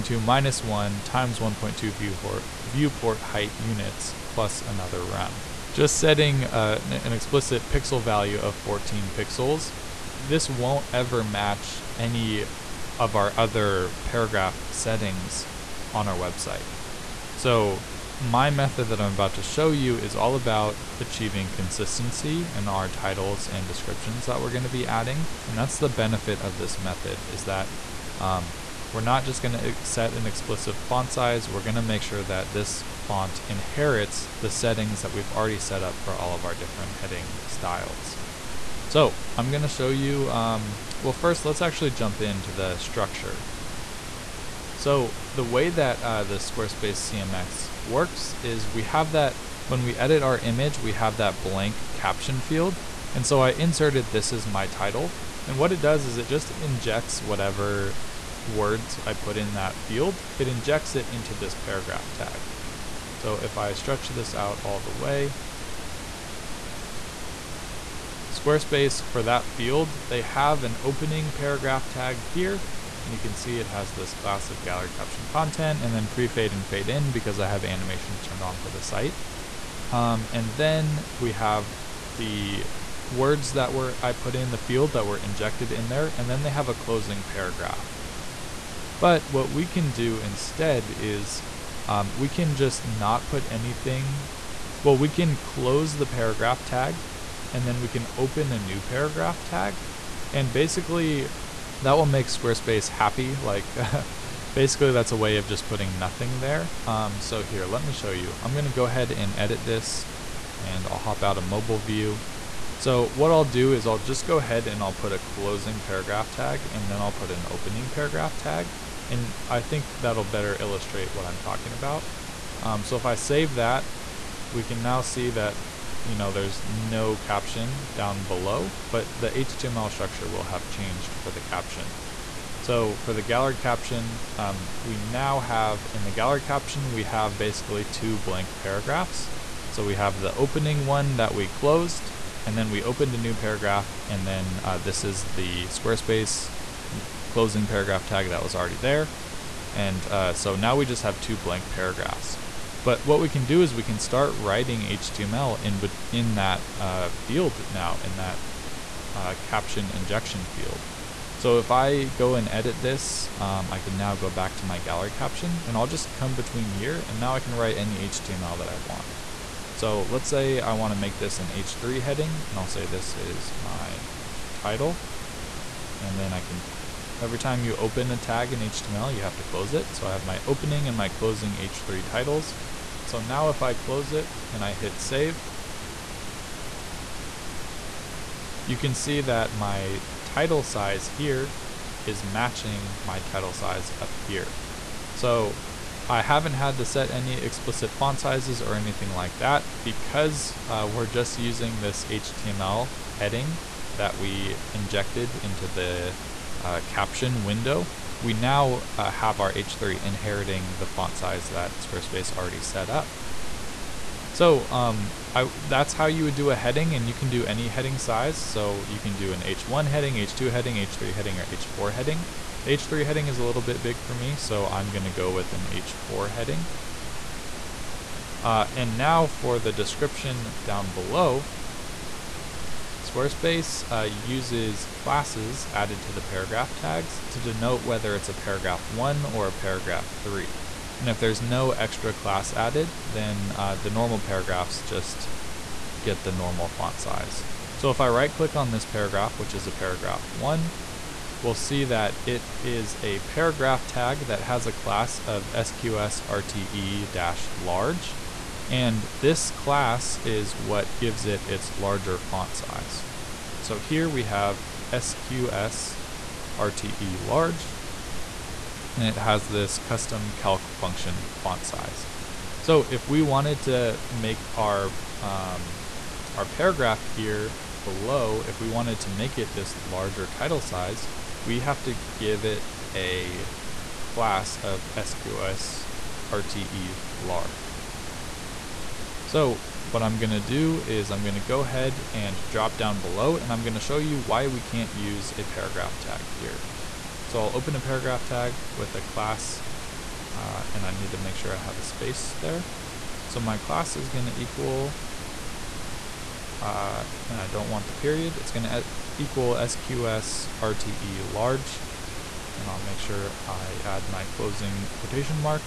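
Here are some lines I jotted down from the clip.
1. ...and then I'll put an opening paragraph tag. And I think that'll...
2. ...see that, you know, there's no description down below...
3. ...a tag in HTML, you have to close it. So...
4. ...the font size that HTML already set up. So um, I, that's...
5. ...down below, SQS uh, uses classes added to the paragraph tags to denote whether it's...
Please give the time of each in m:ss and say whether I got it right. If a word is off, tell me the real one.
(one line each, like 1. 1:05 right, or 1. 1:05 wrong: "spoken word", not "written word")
1. 1:56 right
2. 2:04 wrong: "caption", not "description"
3. 2:58 right
4. 3:30 wrong: "Squarespace", not "HTML"
5. 3:50 wrong: "Squarespace", not "SQS".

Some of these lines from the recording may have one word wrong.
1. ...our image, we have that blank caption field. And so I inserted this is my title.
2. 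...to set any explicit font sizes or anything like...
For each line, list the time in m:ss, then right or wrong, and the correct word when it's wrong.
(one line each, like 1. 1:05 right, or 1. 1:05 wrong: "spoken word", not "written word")
1. 0:50 right
2. 3:16 right.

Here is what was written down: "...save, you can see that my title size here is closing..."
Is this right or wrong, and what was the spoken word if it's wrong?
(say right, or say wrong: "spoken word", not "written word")
wrong: "matching", not "closing".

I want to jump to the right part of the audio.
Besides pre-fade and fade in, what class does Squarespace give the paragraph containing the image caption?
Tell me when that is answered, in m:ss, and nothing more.
1:14.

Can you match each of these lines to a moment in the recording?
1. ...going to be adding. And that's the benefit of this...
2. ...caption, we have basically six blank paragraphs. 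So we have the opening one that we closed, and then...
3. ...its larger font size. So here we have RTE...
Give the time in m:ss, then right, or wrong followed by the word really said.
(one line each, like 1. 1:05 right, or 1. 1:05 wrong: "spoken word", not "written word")
1. 0:24 right
2. 2:16 wrong: "two", not "six"
3. 4:21 wrong: "SQS", not "RTE".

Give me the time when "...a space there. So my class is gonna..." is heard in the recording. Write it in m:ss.
5:01.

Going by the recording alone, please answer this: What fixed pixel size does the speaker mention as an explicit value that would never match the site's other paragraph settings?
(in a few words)
14 pixels.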